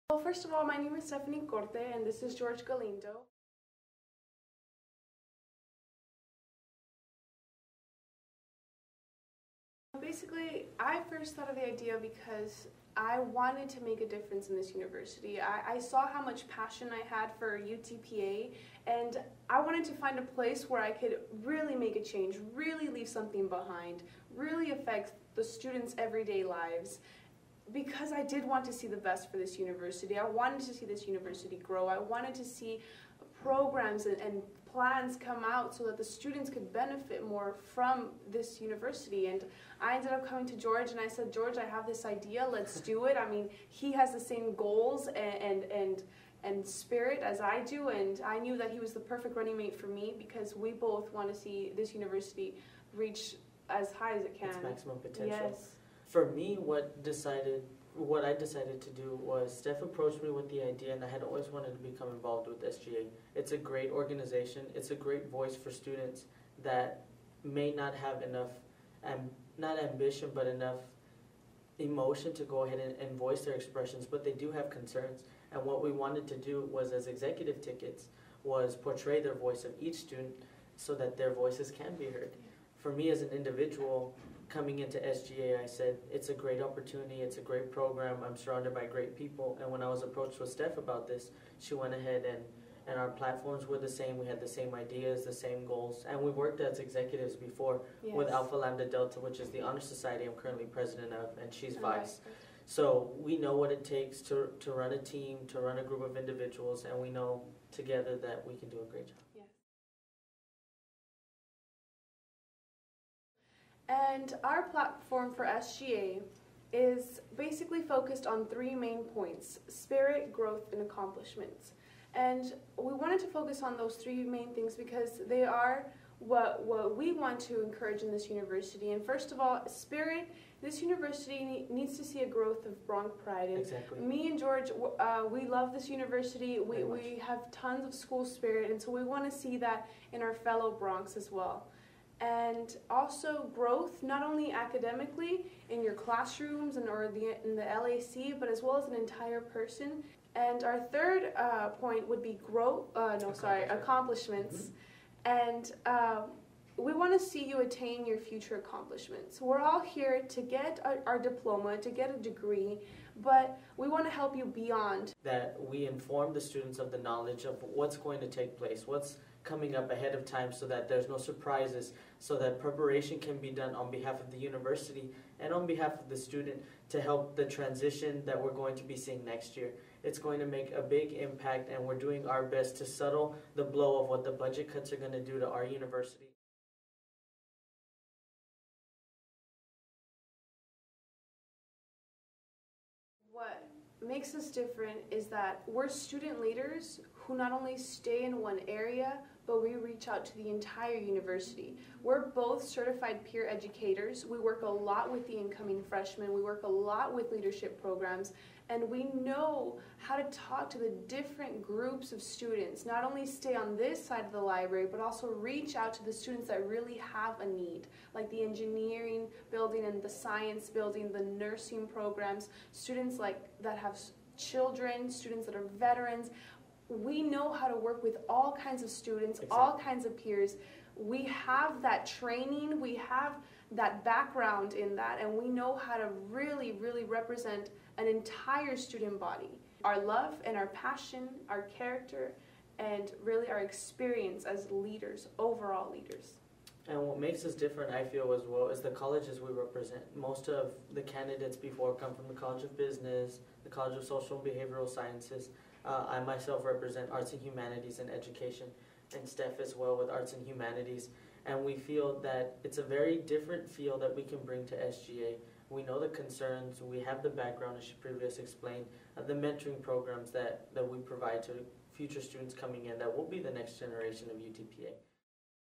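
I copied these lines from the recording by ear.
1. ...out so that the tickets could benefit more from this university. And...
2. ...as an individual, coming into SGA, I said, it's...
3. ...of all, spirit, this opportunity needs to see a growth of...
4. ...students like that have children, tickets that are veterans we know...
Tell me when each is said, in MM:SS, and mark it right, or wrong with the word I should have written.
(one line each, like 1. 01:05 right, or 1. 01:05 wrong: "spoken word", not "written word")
1. 00:35 wrong: "students", not "tickets"
2. 01:23 right
3. 02:09 wrong: "university", not "opportunity"
4. 03:42 wrong: "students", not "tickets".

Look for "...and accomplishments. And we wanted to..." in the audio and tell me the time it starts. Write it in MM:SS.
02:00.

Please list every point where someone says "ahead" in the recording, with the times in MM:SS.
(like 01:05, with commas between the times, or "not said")
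01:12, 01:31, 02:49.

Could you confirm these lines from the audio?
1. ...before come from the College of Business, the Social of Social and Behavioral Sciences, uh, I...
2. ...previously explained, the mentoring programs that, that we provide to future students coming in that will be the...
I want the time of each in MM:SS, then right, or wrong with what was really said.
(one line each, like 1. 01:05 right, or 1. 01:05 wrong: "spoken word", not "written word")
1. 04:11 wrong: "College", not "Social"
2. 04:27 right.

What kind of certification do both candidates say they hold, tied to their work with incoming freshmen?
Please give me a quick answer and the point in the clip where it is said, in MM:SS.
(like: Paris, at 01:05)
certified peer educators, at 03:22.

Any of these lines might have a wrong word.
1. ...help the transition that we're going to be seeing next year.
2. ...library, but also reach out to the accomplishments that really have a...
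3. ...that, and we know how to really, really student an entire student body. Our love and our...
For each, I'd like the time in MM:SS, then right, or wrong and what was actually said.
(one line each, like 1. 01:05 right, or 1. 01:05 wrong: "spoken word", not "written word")
1. 02:57 right
2. 03:34 wrong: "students", not "accomplishments"
3. 03:54 wrong: "represent", not "student".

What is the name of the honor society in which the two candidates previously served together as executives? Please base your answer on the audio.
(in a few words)
Alpha Lambda Delta.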